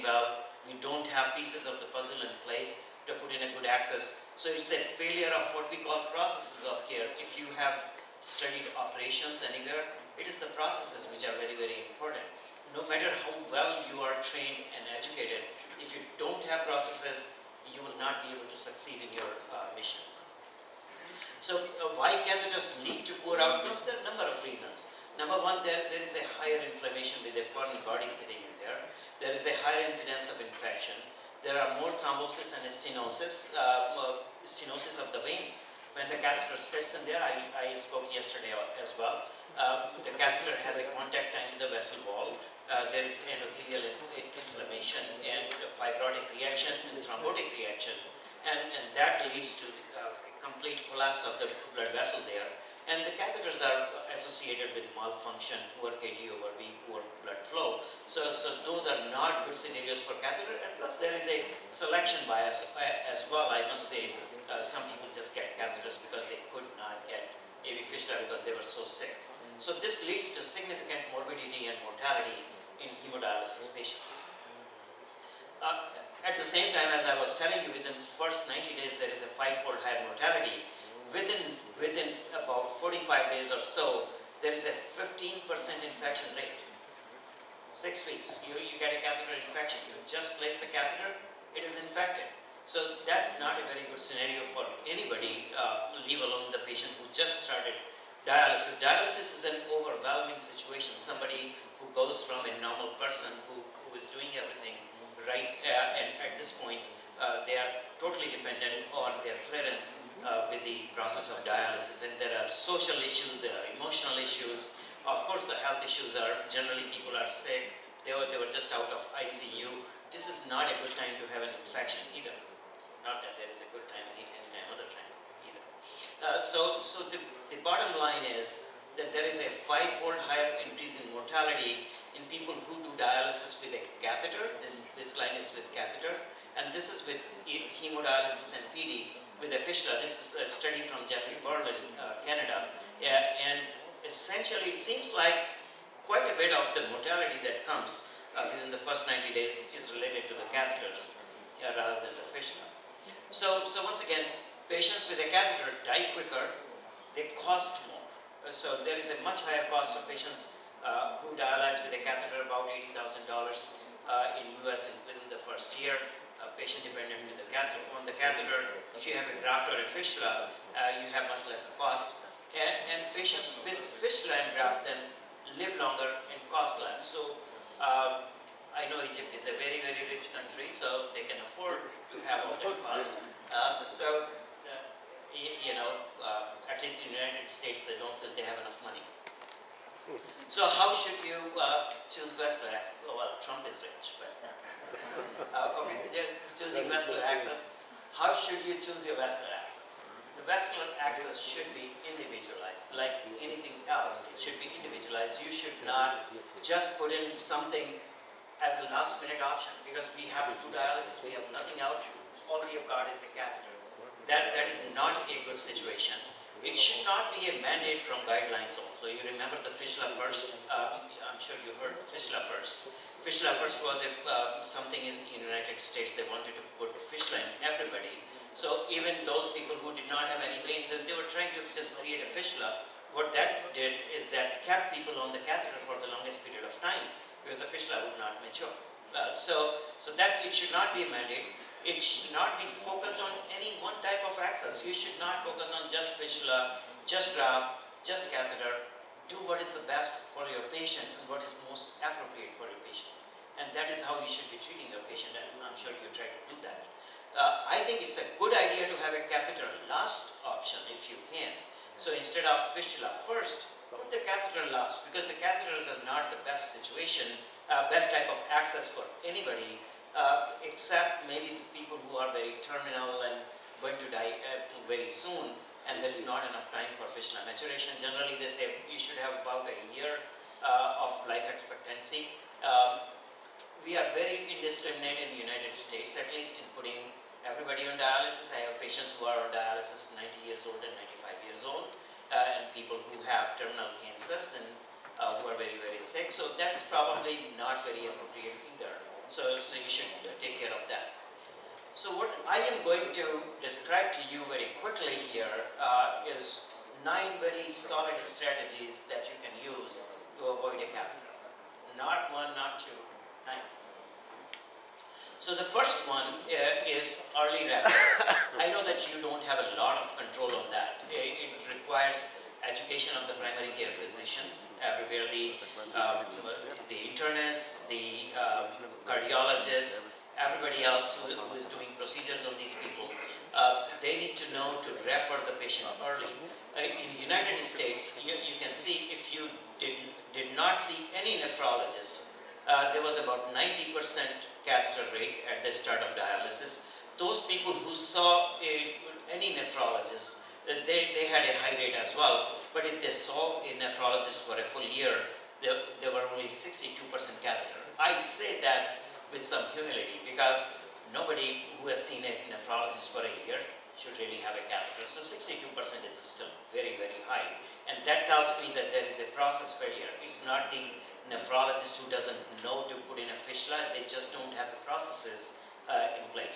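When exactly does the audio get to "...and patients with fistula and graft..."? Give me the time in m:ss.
2:52.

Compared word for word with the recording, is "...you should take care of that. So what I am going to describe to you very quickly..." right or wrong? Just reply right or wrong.
right.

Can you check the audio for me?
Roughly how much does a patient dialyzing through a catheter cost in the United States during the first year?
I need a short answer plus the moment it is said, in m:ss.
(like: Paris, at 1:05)
$80,000, at 2:42.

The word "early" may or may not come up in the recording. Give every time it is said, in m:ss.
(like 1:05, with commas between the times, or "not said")
5:17, 5:36.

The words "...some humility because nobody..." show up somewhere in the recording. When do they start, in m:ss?
5:59.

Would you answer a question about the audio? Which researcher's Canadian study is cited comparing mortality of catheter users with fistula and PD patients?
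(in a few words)
Jeffrey Berlin.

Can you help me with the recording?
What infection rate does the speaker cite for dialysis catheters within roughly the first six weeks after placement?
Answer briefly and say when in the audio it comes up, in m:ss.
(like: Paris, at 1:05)
15%, at 1:24.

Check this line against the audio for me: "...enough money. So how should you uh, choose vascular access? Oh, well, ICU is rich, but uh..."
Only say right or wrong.
wrong.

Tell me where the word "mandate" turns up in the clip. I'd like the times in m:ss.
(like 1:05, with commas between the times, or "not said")
3:37, 4:01.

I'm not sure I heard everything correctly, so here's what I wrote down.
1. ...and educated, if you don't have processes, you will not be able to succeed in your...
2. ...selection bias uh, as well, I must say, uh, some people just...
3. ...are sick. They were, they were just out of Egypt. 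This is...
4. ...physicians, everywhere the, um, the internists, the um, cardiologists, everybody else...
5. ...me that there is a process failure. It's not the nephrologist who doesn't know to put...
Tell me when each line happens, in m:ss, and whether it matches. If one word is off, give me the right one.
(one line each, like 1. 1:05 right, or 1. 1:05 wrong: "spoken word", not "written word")
1. 0:14 right
2. 1:01 right
3. 1:57 wrong: "ICU", not "Egypt"
4. 5:24 right
5. 6:08 right.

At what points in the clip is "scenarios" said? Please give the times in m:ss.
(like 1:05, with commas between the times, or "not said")
0:59, 1:33.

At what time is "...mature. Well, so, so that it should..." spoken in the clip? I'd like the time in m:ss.
3:58.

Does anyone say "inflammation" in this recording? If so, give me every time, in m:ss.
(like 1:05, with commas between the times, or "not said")
0:26, 0:44.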